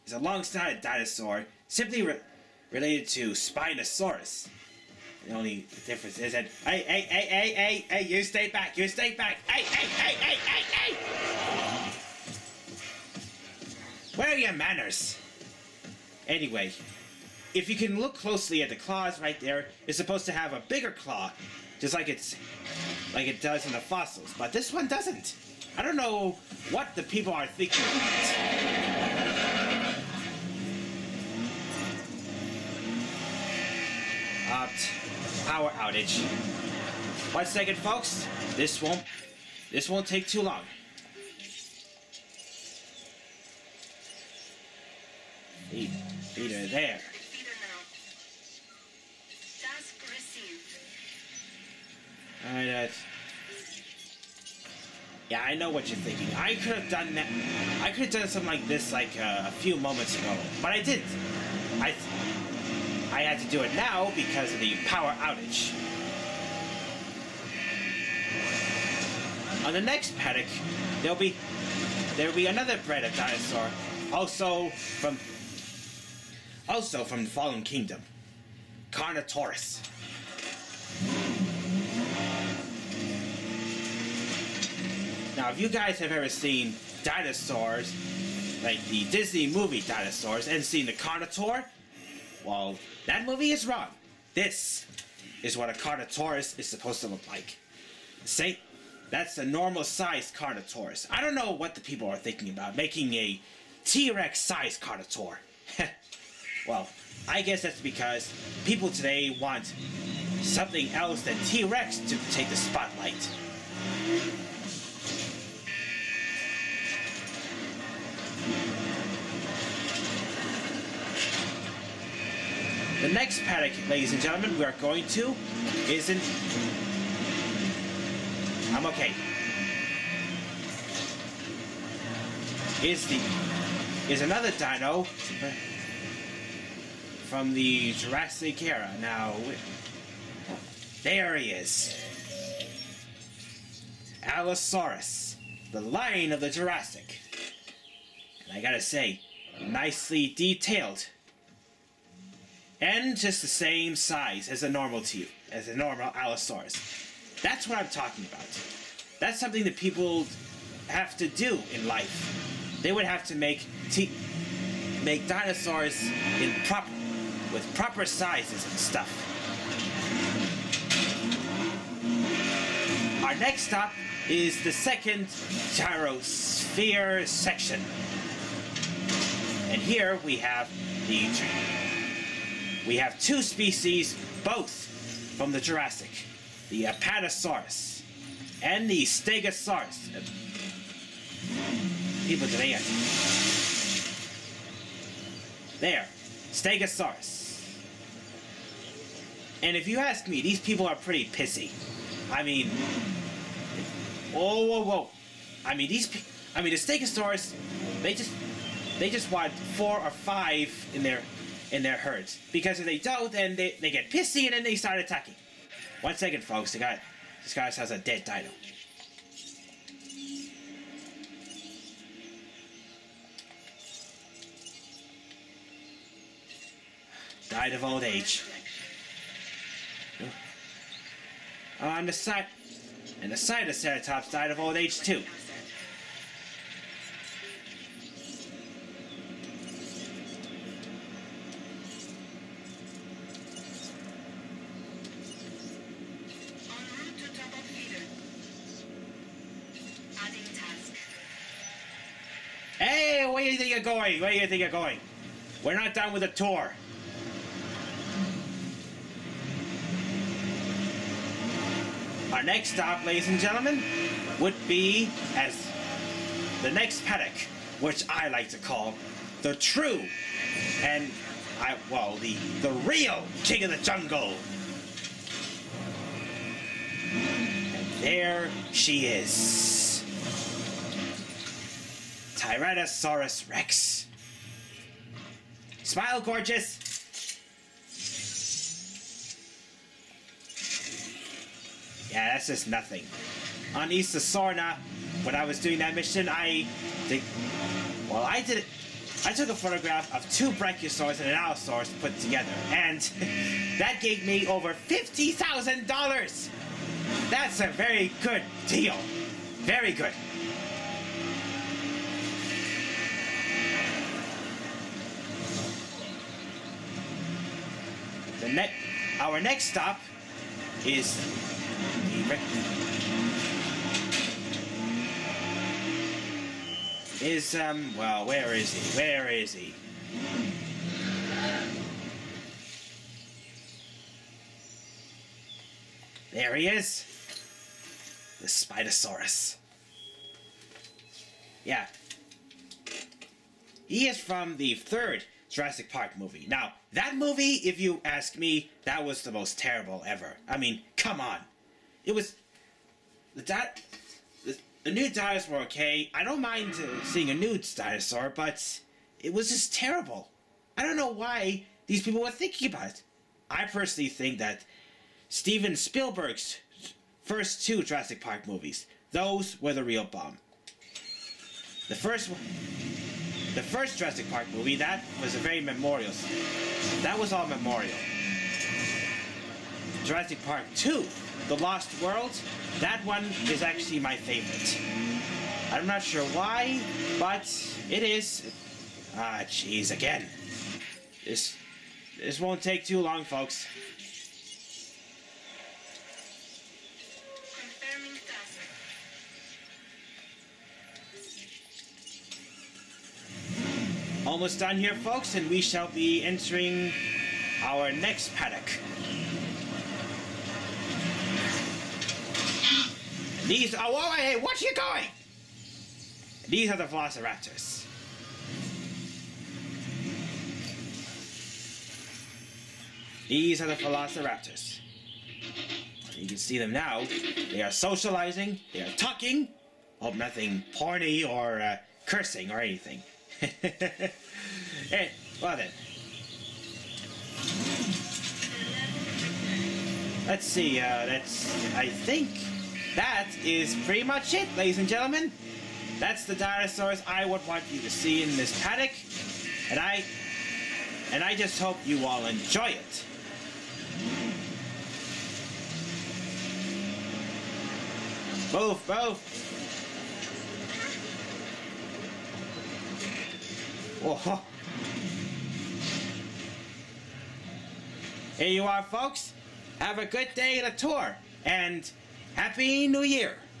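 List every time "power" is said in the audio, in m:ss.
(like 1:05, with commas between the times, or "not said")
0:35, 1:04.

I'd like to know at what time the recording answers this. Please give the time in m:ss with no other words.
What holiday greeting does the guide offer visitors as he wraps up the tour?
7:52.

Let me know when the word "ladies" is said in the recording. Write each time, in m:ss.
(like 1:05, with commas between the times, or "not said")
2:03, 4:23, 7:24.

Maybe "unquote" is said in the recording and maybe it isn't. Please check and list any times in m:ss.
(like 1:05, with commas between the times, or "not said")
not said.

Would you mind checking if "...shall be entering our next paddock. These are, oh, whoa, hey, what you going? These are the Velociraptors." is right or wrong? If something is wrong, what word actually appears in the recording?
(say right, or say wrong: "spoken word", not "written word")
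right.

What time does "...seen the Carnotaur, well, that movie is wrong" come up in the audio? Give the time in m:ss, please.
1:30.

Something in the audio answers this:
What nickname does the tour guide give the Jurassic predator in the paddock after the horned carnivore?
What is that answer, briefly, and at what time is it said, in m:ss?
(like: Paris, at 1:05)
the lion of the Jurassic, at 2:25.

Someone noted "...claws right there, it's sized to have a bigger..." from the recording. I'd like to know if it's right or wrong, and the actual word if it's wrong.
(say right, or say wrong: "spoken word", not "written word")
wrong: "supposed", not "sized".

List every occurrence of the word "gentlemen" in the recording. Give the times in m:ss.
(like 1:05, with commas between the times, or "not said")
2:04, 4:23, 7:24.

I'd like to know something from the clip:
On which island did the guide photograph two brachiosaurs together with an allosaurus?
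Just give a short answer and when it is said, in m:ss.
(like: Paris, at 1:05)
Isla Sorna, at 4:53.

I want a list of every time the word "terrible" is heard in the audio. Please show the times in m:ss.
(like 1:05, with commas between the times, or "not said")
5:49, 5:59.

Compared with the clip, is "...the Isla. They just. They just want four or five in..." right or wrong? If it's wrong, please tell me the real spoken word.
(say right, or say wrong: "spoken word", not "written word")
wrong: "Stegosaurus", not "Isla".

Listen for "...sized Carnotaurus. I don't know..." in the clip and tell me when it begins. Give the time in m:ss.
1:39.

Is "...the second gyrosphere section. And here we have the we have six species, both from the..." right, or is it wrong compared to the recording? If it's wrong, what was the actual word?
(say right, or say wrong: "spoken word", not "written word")
wrong: "two", not "six".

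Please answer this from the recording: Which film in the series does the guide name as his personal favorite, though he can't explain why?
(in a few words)
The Lost World.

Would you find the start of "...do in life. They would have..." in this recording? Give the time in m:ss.
2:41.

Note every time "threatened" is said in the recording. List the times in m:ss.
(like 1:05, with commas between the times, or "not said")
not said.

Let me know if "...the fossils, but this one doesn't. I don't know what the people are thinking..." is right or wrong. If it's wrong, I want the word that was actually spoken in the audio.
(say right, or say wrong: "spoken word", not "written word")
right.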